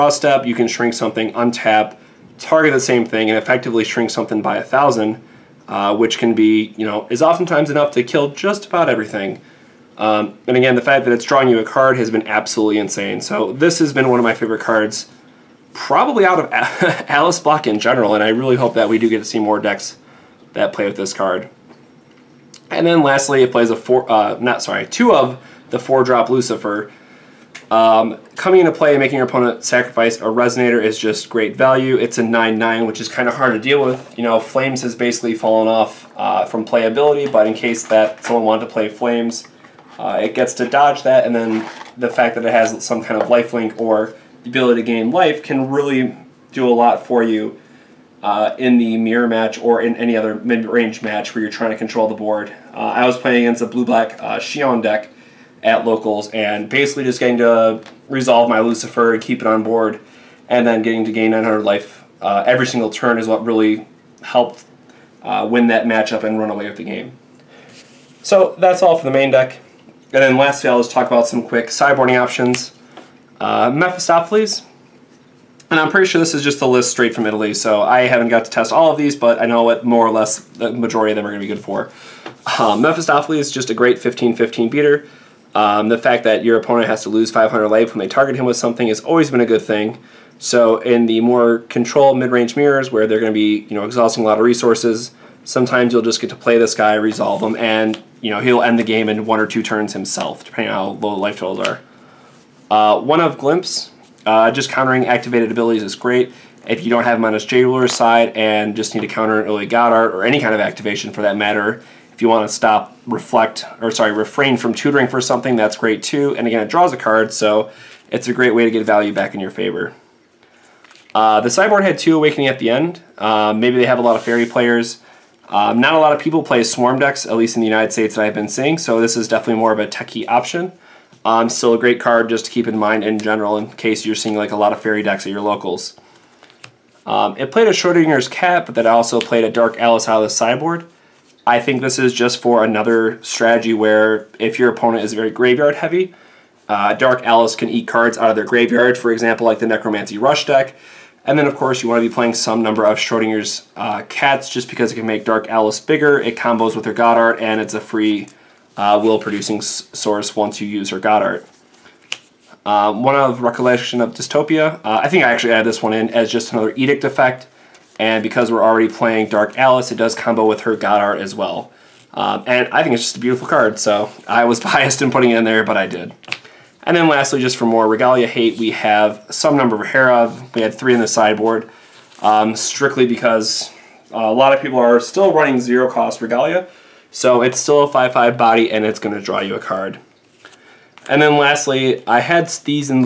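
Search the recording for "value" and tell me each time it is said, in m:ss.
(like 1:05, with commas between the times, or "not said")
0:31, 1:58.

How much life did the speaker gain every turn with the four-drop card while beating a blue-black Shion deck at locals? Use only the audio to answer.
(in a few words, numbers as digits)
900.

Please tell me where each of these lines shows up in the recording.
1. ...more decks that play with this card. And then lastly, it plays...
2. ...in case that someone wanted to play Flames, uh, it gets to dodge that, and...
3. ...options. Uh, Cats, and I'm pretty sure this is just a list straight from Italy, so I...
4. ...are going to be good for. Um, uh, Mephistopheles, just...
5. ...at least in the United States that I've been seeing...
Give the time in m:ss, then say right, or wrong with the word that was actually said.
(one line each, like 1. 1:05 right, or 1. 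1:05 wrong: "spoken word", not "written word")
1. 0:19 right
2. 0:37 right
3. 1:12 wrong: "Mephistopheles", not "Cats"
4. 1:21 right
5. 2:07 right.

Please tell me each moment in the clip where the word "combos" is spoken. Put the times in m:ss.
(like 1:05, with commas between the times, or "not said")
2:36, 2:50.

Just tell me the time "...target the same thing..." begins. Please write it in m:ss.
0:02.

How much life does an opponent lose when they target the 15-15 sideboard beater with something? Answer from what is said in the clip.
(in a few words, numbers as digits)
500.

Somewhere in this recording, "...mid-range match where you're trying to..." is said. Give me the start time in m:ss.
0:50.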